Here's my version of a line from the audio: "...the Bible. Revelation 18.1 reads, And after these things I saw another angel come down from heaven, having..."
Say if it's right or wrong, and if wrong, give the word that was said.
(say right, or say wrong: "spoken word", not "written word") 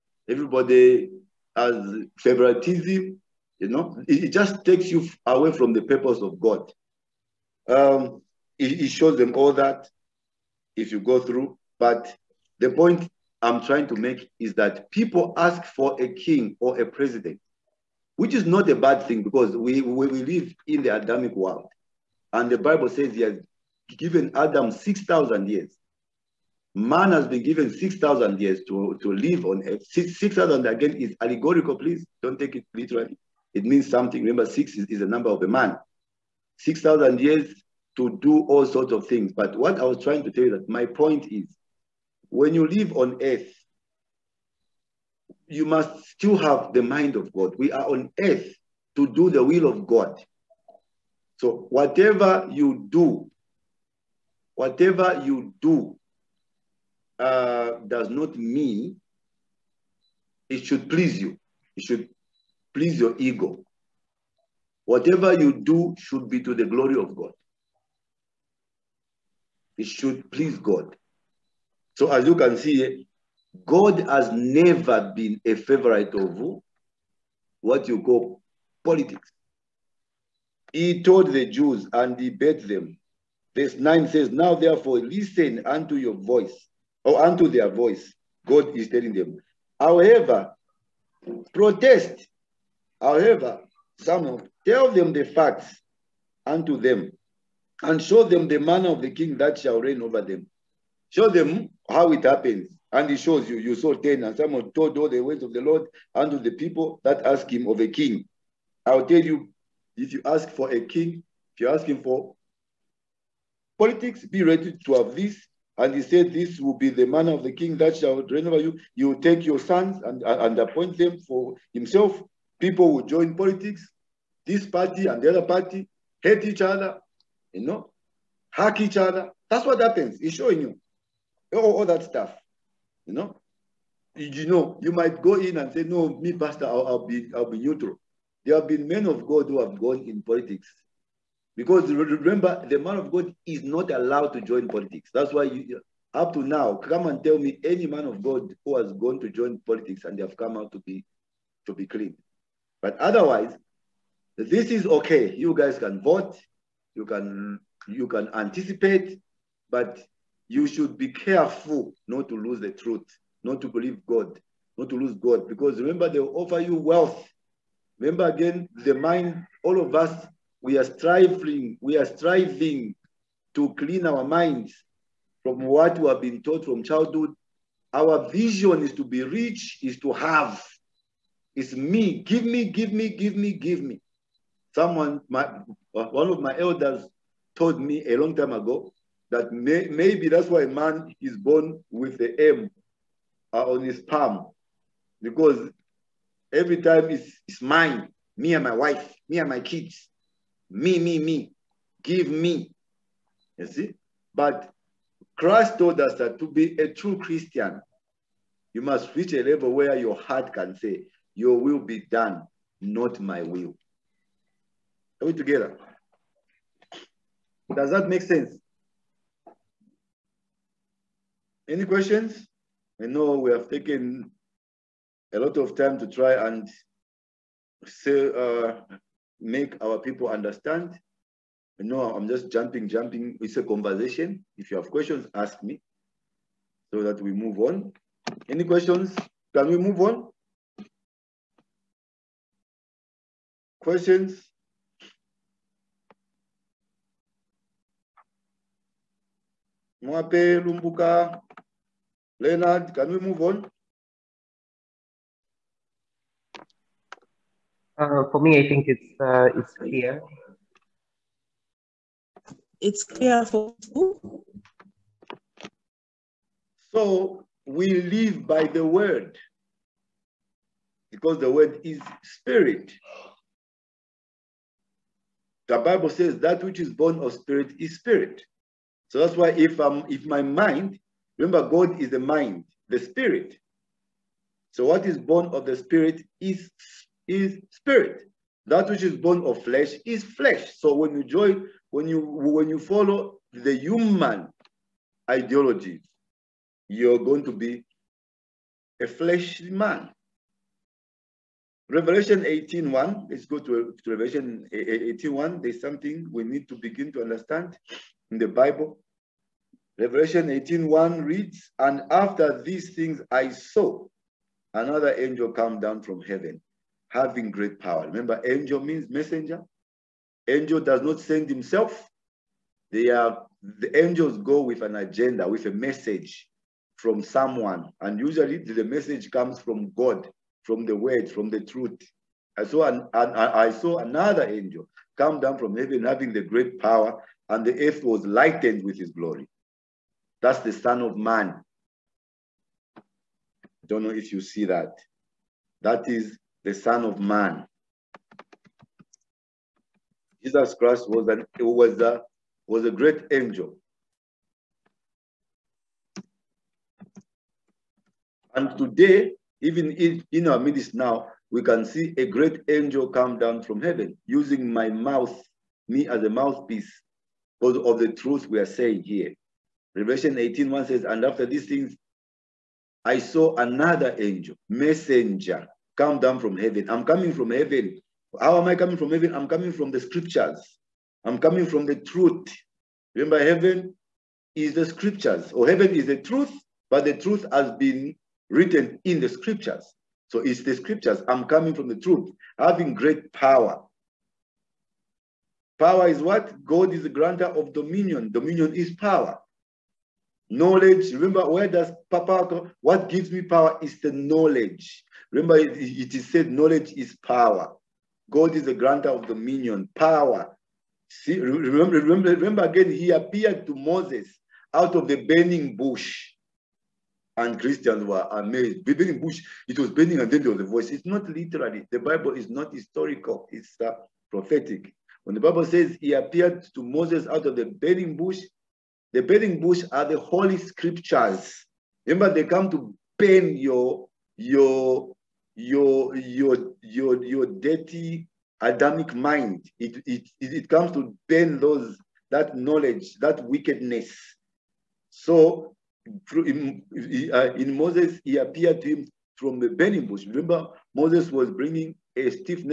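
right.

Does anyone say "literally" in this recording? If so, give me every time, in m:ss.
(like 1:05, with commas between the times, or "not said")
0:32, 7:01.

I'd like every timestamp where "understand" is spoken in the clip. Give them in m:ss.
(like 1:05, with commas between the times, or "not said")
3:50, 5:07.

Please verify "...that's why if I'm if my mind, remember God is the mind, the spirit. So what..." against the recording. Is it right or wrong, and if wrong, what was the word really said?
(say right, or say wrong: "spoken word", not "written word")
right.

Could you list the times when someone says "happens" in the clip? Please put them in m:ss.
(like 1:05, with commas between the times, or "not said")
1:42, 2:09.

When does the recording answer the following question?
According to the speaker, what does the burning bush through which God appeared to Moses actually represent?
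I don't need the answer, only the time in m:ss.
7:10.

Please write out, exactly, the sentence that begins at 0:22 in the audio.
And the Bible says he has given Adam 6,000 years.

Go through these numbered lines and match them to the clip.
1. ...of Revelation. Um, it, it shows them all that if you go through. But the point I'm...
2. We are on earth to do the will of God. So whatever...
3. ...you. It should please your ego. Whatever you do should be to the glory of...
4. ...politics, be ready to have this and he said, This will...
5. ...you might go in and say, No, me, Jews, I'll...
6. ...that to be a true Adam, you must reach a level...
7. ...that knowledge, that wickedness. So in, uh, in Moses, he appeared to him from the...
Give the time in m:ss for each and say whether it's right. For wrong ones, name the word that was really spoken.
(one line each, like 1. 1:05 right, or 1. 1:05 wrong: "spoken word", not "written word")
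1. 0:06 wrong: "God", not "Revelation"
2. 0:47 right
3. 1:01 right
4. 1:53 right
5. 2:14 wrong: "Pastor", not "Jews"
6. 3:26 wrong: "Christian", not "Adam"
7. 7:22 right.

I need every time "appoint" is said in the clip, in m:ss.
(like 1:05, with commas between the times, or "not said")
2:00.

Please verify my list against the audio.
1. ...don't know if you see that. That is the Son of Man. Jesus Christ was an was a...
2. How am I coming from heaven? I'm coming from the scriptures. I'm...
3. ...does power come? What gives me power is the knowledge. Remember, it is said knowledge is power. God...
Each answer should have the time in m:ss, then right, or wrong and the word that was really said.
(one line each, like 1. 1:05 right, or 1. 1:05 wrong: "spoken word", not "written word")
1. 5:43 right
2. 6:18 right
3. 6:41 right.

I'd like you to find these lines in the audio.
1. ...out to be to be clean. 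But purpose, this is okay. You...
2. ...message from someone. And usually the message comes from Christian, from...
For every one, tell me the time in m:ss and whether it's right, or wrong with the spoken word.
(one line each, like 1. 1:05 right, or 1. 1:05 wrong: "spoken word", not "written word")
1. 2:30 wrong: "otherwise", not "purpose"
2. 5:25 wrong: "God", not "Christian".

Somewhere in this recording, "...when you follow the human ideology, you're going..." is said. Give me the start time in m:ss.
4:52.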